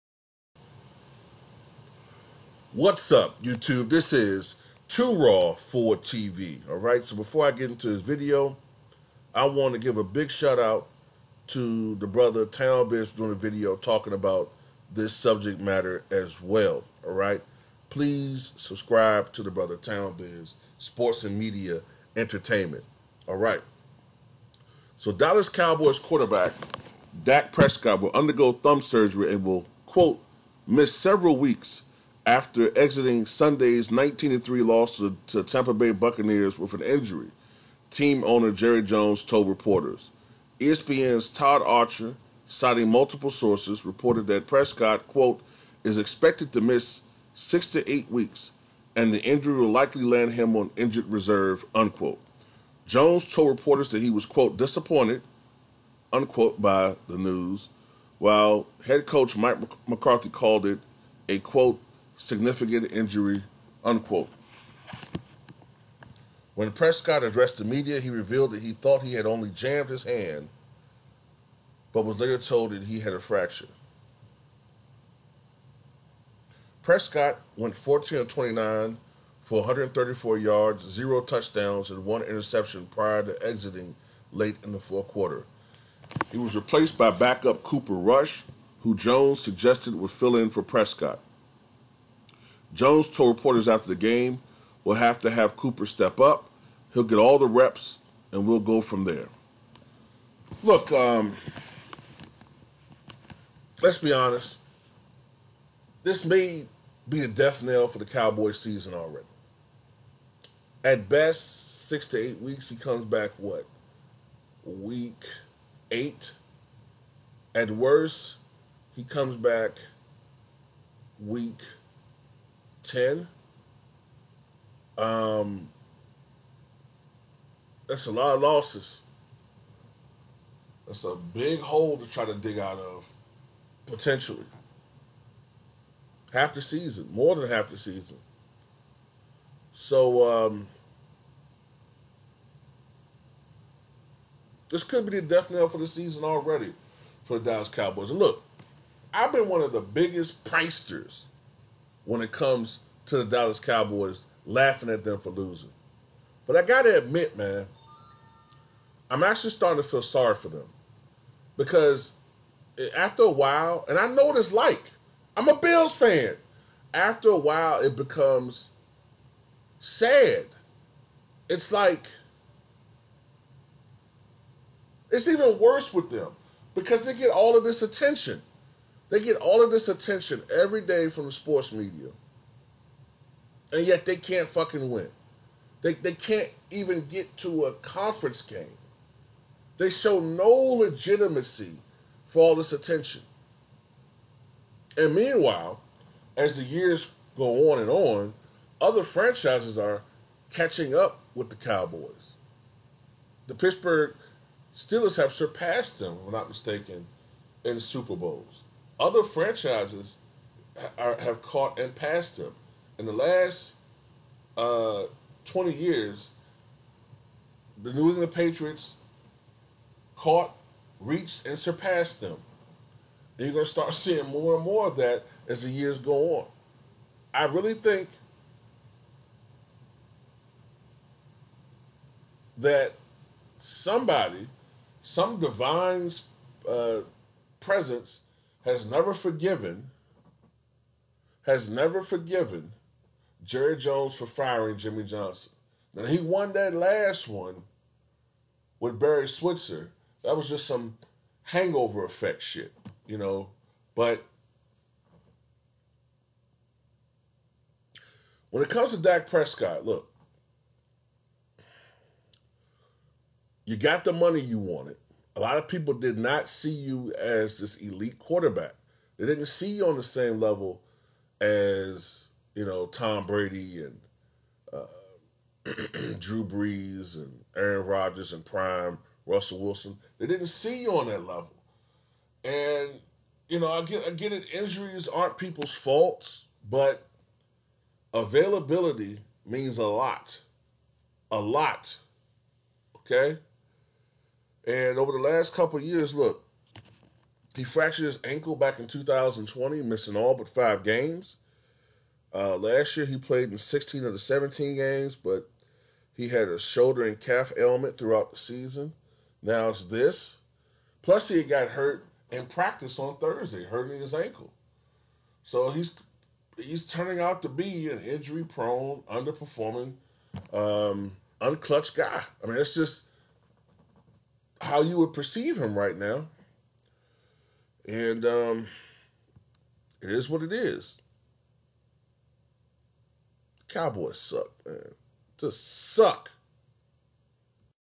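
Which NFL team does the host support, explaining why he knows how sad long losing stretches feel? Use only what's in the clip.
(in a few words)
Bills.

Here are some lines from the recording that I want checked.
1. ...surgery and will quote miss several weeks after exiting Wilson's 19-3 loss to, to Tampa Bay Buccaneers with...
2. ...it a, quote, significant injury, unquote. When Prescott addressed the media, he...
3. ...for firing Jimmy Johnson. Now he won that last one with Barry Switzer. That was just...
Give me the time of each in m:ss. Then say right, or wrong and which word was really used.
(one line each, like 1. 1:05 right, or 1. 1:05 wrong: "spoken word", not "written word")
1. 0:28 wrong: "Sunday", not "Wilson"
2. 1:00 right
3. 4:04 right.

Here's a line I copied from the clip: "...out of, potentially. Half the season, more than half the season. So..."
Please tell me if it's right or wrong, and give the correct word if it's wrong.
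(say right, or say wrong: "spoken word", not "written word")
right.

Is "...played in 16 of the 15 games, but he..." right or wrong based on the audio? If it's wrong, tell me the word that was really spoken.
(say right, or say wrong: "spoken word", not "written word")
wrong: "17", not "15".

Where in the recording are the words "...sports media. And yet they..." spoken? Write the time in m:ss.
3:01.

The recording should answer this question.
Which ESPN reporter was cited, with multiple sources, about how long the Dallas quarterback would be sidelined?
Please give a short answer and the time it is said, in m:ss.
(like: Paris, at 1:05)
Todd Archer, at 0:41.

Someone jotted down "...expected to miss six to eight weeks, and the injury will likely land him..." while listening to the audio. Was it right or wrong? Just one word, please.
right.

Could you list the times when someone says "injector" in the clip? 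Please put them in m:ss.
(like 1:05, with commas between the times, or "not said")
not said.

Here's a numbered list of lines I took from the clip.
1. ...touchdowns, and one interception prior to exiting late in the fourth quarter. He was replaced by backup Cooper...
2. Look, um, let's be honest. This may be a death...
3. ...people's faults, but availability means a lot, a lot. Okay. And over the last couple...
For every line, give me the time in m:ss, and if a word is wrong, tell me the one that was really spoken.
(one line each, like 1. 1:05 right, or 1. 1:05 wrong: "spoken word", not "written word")
1. 1:21 right
2. 1:40 right
3. 4:45 right.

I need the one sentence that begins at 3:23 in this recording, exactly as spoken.
The Pittsburgh Steelers have surpassed them, if I'm not mistaken, in Super Bowls.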